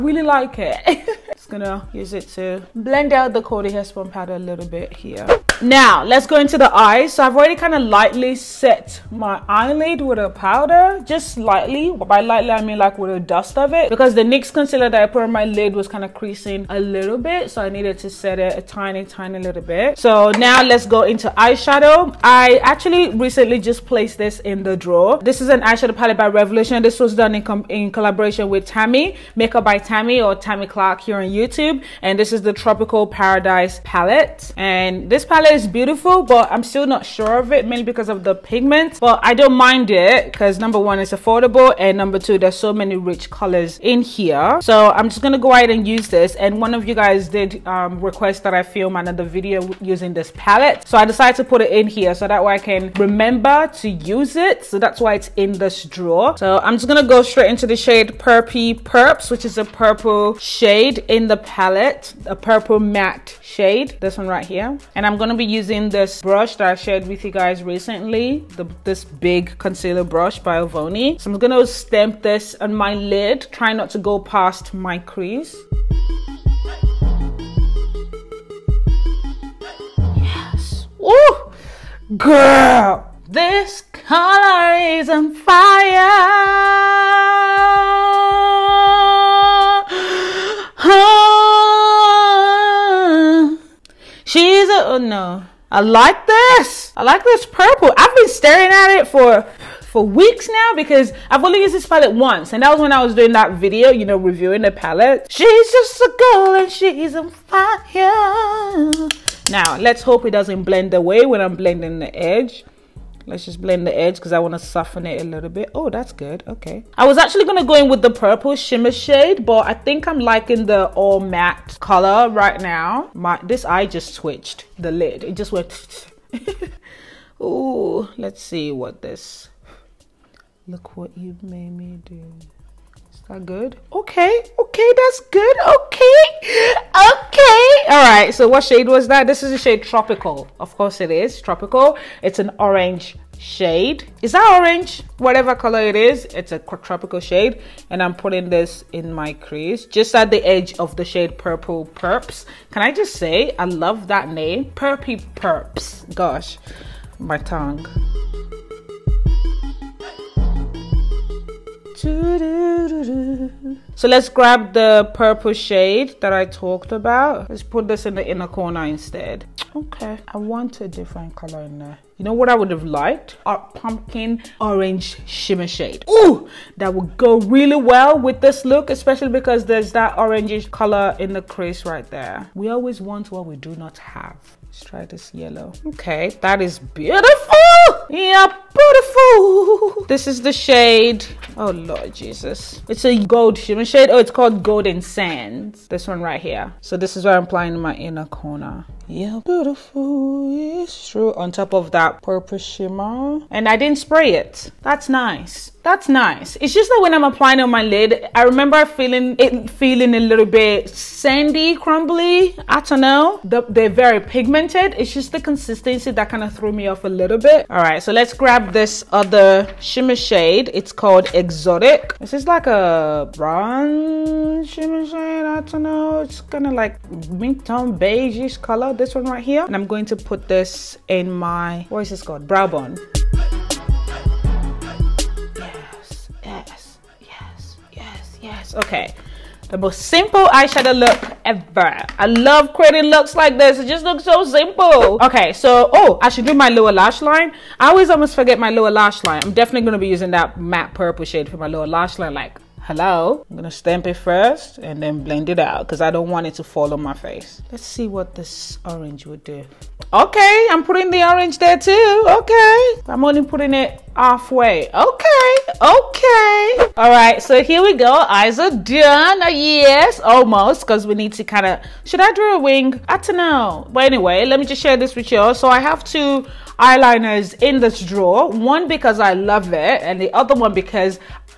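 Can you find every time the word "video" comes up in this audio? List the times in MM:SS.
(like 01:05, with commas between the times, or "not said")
00:49, 01:43.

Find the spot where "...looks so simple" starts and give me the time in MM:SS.
04:04.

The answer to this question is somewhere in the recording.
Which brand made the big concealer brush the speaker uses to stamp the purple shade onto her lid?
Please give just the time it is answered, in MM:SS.
01:10.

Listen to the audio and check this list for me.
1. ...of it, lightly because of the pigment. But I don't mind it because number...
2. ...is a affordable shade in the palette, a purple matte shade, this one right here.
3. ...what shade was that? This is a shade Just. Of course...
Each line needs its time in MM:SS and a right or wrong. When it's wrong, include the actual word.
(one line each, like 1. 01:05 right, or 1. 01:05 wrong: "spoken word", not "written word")
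1. 00:37 wrong: "mainly", not "lightly"
2. 00:59 wrong: "purple", not "affordable"
3. 02:18 wrong: "Tropical", not "Just".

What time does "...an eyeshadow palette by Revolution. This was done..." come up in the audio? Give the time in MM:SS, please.
00:25.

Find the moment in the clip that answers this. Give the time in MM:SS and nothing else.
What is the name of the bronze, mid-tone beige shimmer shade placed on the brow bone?
03:41.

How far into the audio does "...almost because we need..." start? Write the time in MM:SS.
04:30.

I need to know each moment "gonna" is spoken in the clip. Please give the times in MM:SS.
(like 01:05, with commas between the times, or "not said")
00:01, 01:11, 04:13.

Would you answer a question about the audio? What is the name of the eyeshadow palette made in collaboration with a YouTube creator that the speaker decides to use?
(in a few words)
Tropical Paradise.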